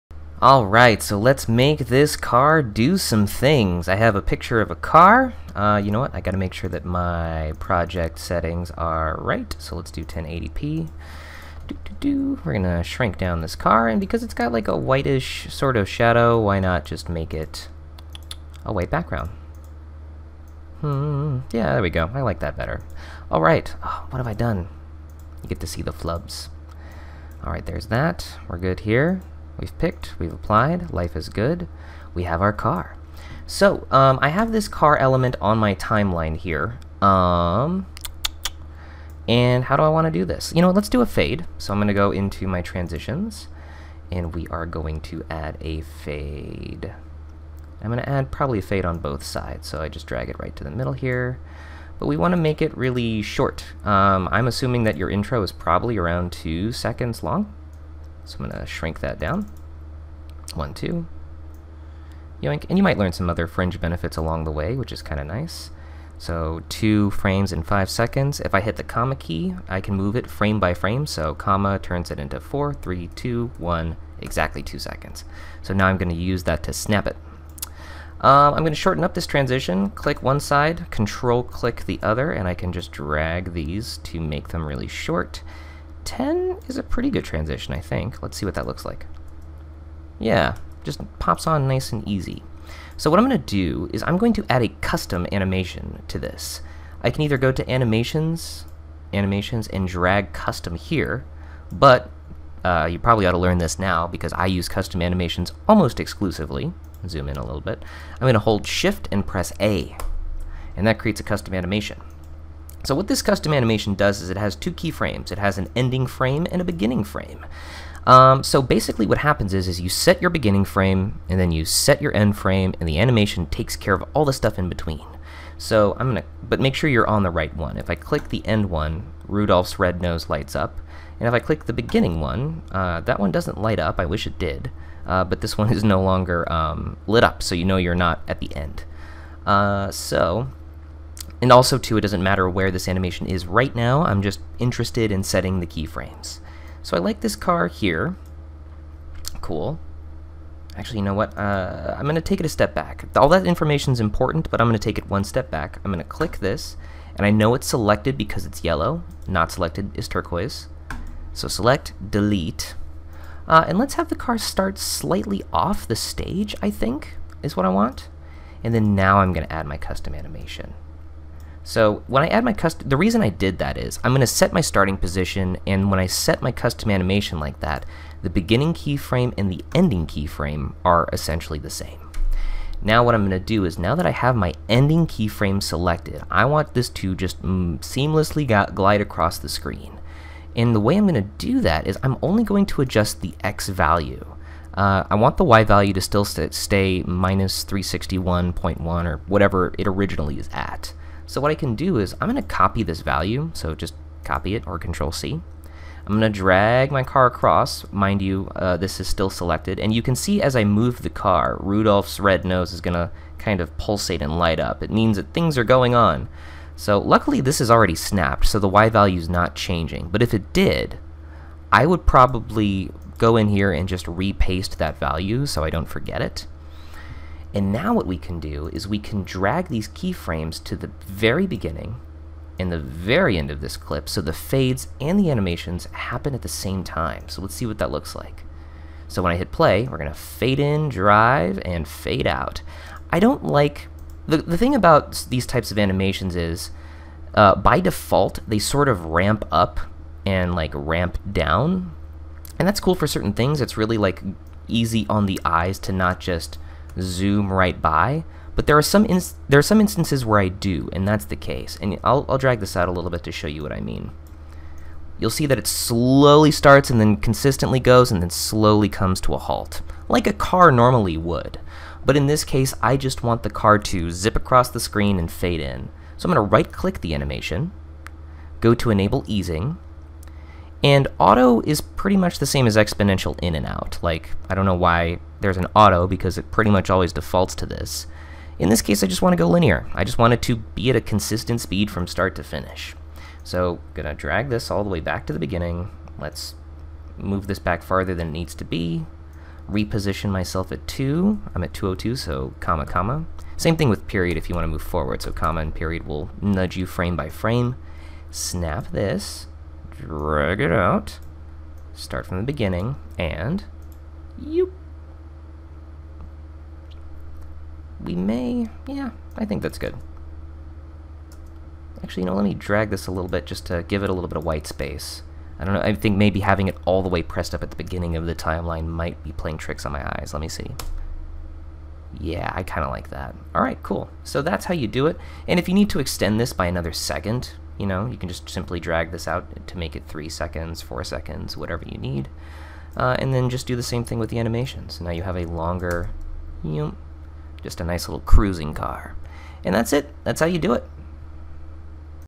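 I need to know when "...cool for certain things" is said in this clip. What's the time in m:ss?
4:12.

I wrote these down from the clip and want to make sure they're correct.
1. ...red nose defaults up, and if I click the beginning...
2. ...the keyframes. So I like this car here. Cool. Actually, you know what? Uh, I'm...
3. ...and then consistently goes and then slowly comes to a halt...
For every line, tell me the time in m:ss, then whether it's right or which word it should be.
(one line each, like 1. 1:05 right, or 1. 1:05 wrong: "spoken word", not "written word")
1. 2:09 wrong: "lights", not "defaults"
2. 2:25 right
3. 4:26 right.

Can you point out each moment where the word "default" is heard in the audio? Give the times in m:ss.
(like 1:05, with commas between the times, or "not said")
4:07, 4:47.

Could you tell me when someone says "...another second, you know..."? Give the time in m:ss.
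5:36.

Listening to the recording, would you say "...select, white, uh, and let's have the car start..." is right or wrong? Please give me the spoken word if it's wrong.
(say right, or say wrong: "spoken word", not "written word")
wrong: "delete", not "white".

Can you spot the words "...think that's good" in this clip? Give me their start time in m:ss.
5:19.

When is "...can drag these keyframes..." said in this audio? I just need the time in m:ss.
3:48.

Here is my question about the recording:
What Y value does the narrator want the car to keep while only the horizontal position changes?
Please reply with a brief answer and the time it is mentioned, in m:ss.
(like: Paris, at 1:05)
-361.1, at 3:17.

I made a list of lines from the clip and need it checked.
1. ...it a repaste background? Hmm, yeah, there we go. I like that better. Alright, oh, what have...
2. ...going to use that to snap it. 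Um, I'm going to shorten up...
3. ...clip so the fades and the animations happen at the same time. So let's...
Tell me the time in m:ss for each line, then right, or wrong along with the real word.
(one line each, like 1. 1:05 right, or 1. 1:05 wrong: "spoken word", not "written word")
1. 0:17 wrong: "white", not "repaste"
2. 1:15 right
3. 3:53 right.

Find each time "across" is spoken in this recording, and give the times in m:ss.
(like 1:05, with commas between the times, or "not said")
3:08, 3:27, 4:34.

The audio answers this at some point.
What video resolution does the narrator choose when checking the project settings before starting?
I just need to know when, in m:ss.
0:10.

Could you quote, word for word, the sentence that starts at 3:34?
It means that things are going on.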